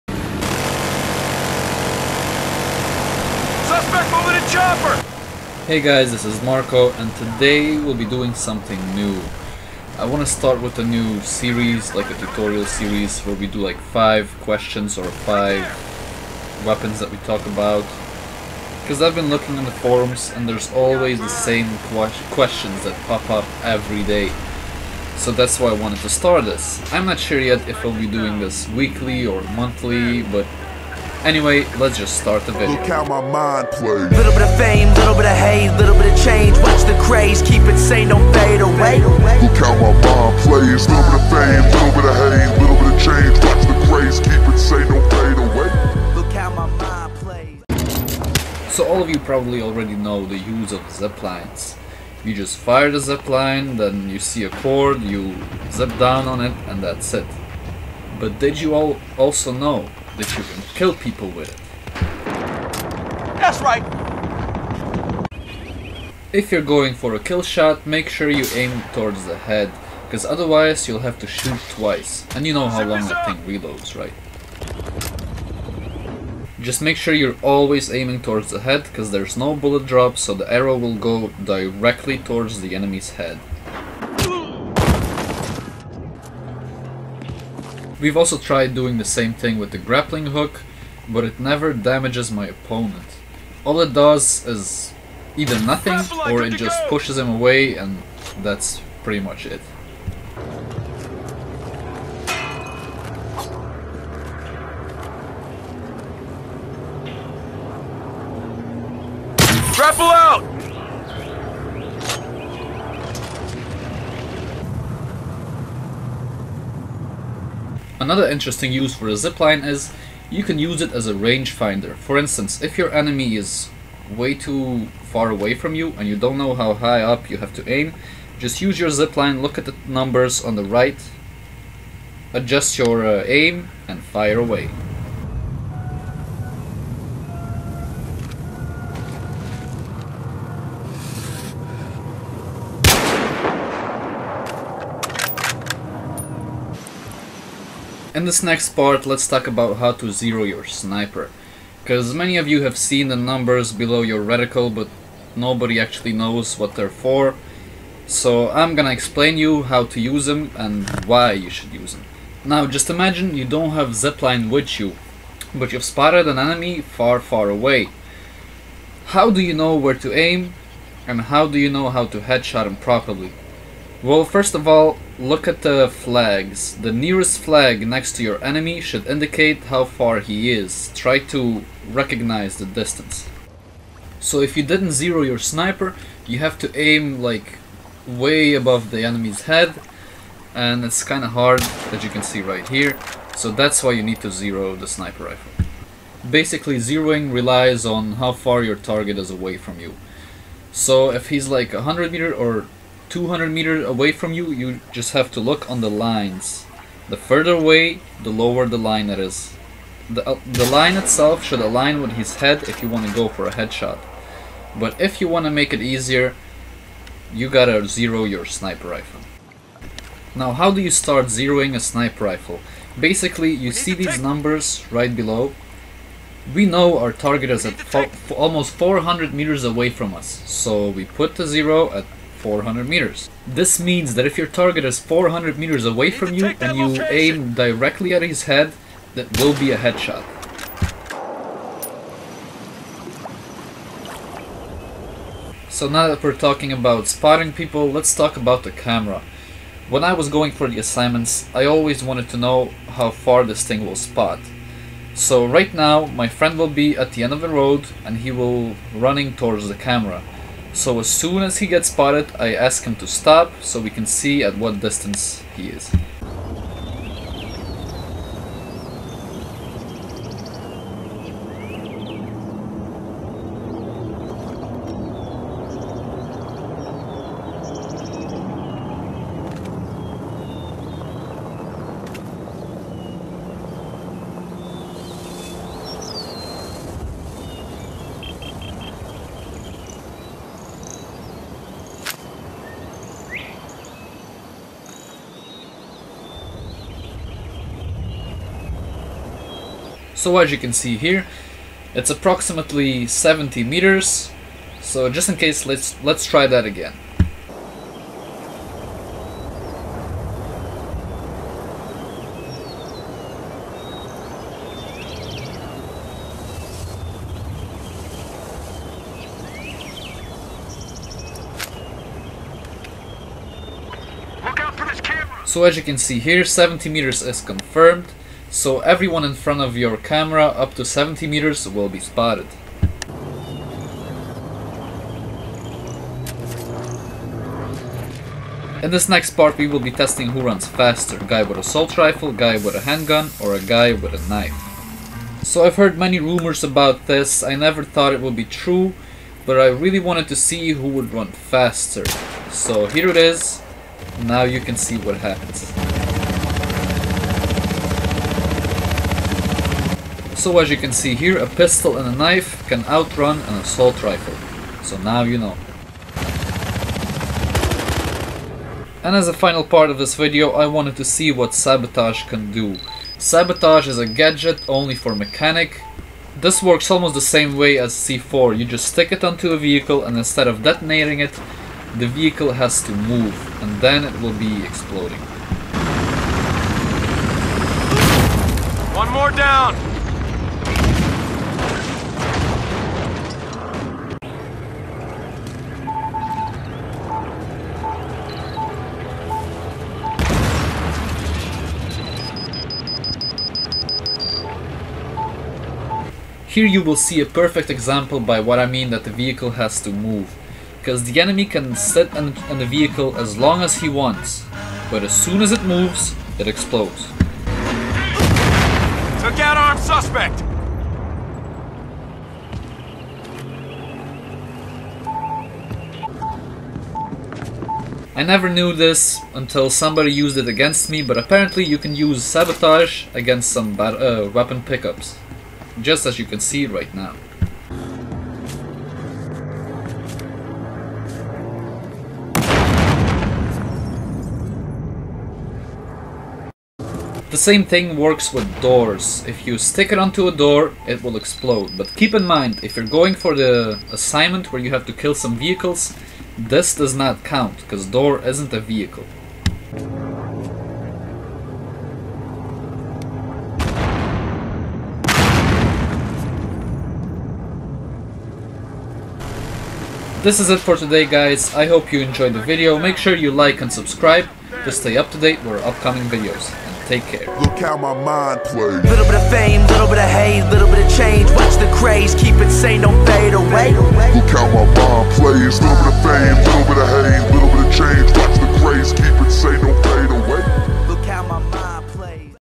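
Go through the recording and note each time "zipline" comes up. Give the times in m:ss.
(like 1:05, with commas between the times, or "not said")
1:59, 2:08, 2:44.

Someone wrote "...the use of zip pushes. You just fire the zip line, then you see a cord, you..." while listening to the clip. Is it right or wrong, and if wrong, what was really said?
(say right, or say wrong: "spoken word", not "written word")
wrong: "lines", not "pushes".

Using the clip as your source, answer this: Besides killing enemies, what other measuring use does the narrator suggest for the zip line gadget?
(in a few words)
rangefinder.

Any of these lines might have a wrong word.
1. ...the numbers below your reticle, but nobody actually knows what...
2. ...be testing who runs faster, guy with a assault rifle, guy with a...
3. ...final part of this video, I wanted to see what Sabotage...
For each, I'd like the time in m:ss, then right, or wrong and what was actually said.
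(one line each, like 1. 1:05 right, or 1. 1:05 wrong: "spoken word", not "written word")
1. 2:33 right
2. 5:39 right
3. 6:09 right.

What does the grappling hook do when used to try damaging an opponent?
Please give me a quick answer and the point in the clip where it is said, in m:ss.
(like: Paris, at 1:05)
pushes him away, at 1:36.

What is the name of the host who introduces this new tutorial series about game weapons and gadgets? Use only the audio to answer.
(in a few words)
Marco.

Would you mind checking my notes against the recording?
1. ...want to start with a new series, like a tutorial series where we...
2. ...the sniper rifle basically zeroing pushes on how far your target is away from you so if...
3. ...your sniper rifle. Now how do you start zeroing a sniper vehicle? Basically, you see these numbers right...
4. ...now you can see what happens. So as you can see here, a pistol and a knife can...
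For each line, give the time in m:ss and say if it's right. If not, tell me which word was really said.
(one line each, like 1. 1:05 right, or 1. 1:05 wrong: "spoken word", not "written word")
1. 0:10 right
2. 3:14 wrong: "relies", not "pushes"
3. 3:38 wrong: "rifle", not "vehicle"
4. 5:54 right.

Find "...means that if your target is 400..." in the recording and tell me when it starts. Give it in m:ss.
3:53.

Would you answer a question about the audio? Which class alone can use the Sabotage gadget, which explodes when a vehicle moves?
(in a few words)
mechanic.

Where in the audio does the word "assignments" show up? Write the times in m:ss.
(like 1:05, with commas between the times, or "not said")
4:10, 7:33.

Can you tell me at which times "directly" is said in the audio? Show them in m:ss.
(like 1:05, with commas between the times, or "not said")
1:21, 3:57.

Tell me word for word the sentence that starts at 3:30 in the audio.
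The, uh, the line itself should align with his head if you want to go for a headshot.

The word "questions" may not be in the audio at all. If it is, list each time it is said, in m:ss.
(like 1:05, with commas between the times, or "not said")
0:14, 0:22.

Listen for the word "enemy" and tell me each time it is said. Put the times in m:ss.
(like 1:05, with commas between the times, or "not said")
1:22, 2:02, 2:46, 2:58, 3:09, 6:51.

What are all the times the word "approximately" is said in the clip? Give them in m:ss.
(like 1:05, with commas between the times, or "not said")
5:02.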